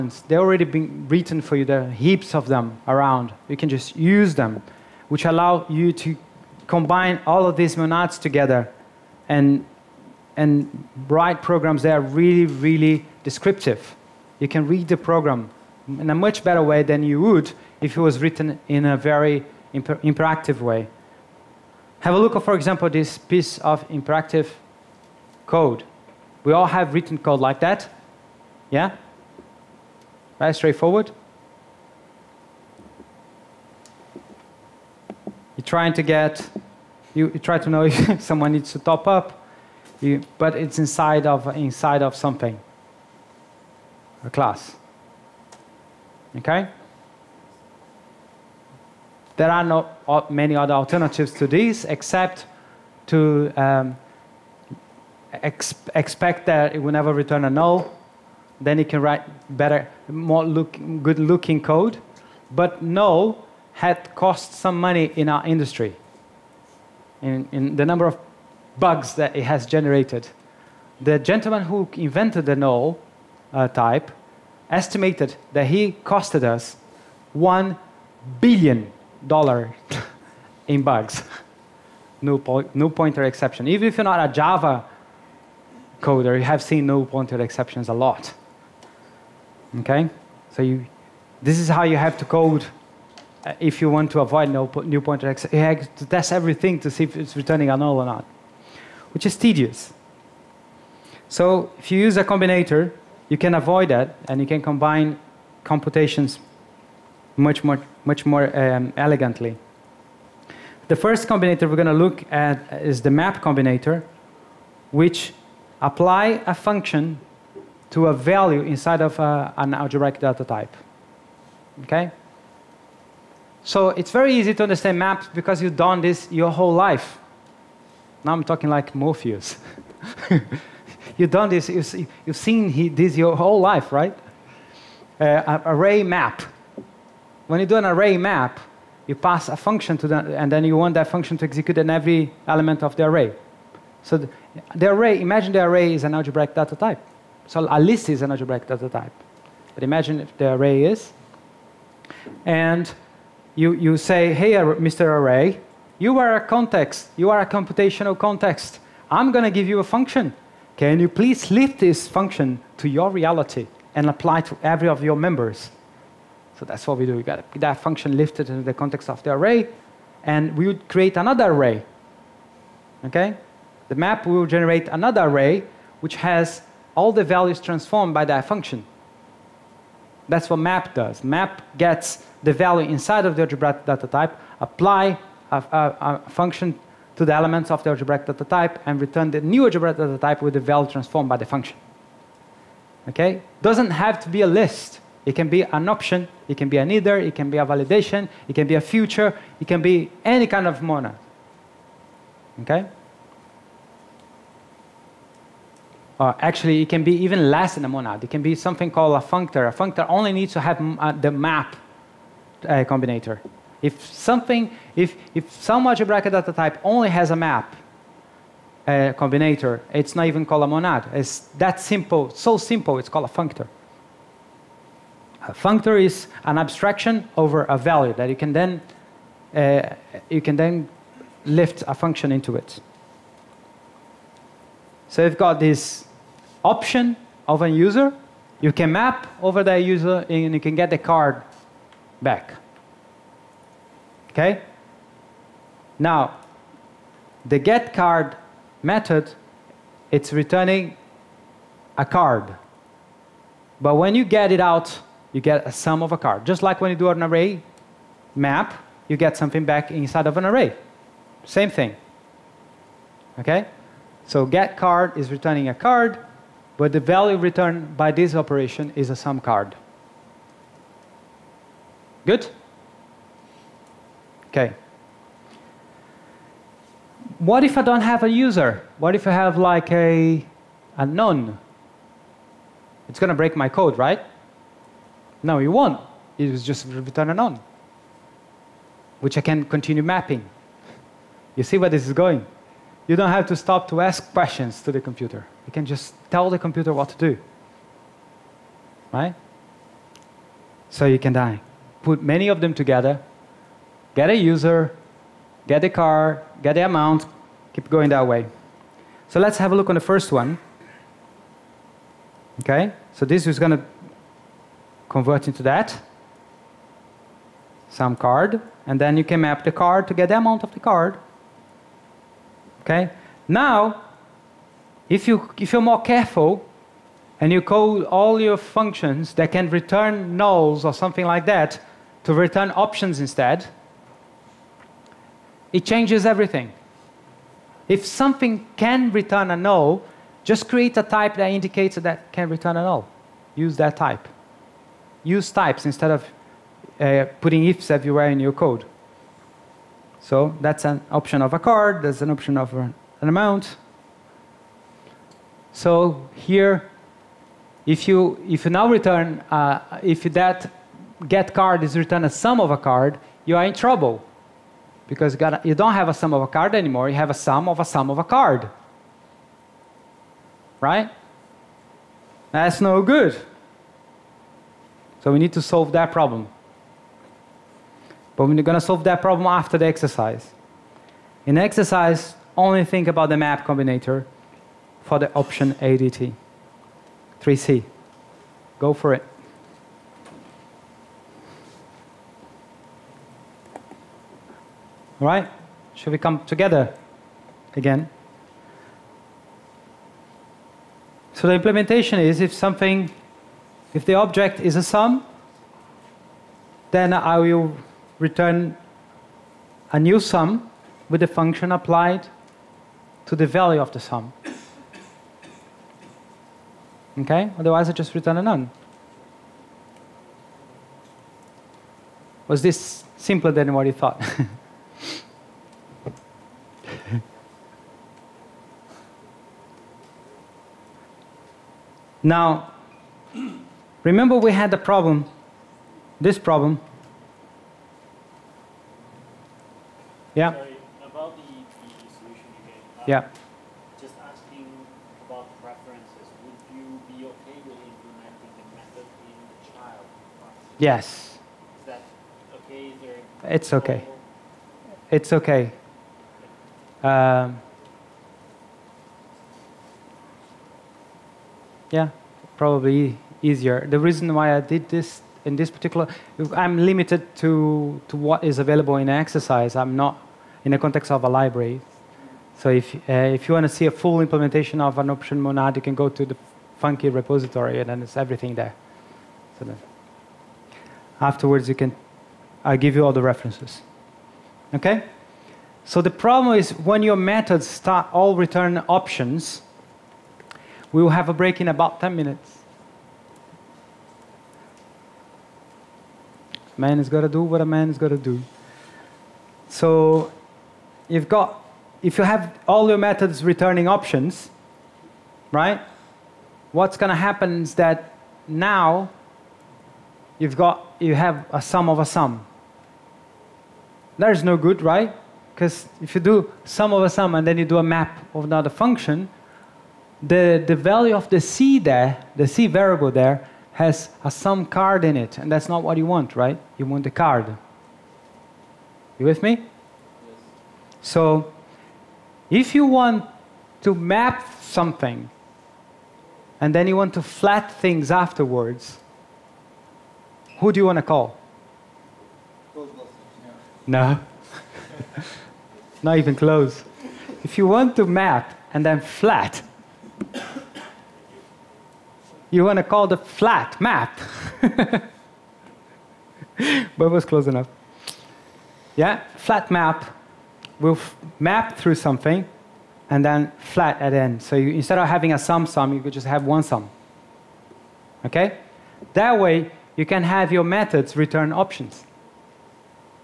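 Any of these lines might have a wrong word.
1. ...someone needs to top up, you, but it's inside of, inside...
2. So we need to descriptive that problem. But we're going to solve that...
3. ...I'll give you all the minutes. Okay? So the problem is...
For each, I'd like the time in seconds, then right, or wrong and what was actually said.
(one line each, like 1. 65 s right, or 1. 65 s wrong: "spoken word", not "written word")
1. 38 s right
2. 375 s wrong: "solve", not "descriptive"
3. 482 s wrong: "references", not "minutes".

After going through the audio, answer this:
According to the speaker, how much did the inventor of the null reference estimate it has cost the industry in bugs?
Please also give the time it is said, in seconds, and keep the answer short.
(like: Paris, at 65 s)
1 billion dollars, at 77 s.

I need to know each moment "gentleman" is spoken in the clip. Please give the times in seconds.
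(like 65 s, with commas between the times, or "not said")
71 s.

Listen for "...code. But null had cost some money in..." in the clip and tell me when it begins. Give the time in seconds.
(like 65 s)
61 s.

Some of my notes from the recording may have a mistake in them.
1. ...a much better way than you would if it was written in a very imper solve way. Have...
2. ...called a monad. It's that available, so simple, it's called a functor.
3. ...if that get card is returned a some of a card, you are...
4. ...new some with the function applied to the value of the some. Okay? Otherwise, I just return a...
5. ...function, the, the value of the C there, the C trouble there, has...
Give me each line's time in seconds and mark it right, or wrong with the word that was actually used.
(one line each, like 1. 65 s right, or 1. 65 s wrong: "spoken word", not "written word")
1. 16 s wrong: "interactive", not "solve"
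2. 220 s wrong: "simple", not "available"
3. 360 s right
4. 409 s right
5. 518 s wrong: "variable", not "trouble".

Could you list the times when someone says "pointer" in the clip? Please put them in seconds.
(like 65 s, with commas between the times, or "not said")
82 s, 87 s, 95 s.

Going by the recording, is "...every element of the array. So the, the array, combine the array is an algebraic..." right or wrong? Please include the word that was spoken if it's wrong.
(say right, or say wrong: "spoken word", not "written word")
wrong: "imagine", not "combine".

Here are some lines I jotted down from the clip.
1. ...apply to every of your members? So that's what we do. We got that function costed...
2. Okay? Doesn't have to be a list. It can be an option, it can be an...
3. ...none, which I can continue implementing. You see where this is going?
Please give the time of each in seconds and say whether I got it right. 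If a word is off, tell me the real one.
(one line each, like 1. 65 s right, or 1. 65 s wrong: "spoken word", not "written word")
1. 164 s wrong: "lifted", not "costed"
2. 193 s right
3. 287 s wrong: "mapping", not "implementing".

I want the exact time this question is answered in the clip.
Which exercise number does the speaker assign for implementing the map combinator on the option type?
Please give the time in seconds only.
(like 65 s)
387 s.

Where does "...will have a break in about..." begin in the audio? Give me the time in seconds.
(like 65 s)
491 s.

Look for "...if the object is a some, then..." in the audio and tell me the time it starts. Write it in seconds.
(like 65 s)
403 s.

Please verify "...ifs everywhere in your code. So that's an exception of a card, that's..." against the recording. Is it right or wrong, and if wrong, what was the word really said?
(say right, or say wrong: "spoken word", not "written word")
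wrong: "option", not "exception".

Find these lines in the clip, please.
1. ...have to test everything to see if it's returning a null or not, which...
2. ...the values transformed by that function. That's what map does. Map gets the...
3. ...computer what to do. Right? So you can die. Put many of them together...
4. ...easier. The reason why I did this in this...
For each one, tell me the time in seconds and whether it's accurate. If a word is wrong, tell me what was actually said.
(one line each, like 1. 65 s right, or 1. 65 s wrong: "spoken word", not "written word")
1. 95 s right
2. 177 s right
3. 296 s right
4. 463 s right.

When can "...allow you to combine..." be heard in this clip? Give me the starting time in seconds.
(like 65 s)
5 s.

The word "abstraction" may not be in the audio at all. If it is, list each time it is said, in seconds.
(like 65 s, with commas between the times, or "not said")
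226 s.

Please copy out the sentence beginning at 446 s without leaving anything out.
Would you be okay with implementing the method in the child?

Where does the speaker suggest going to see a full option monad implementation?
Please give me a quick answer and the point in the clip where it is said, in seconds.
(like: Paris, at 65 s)
funky repository, at 476 s.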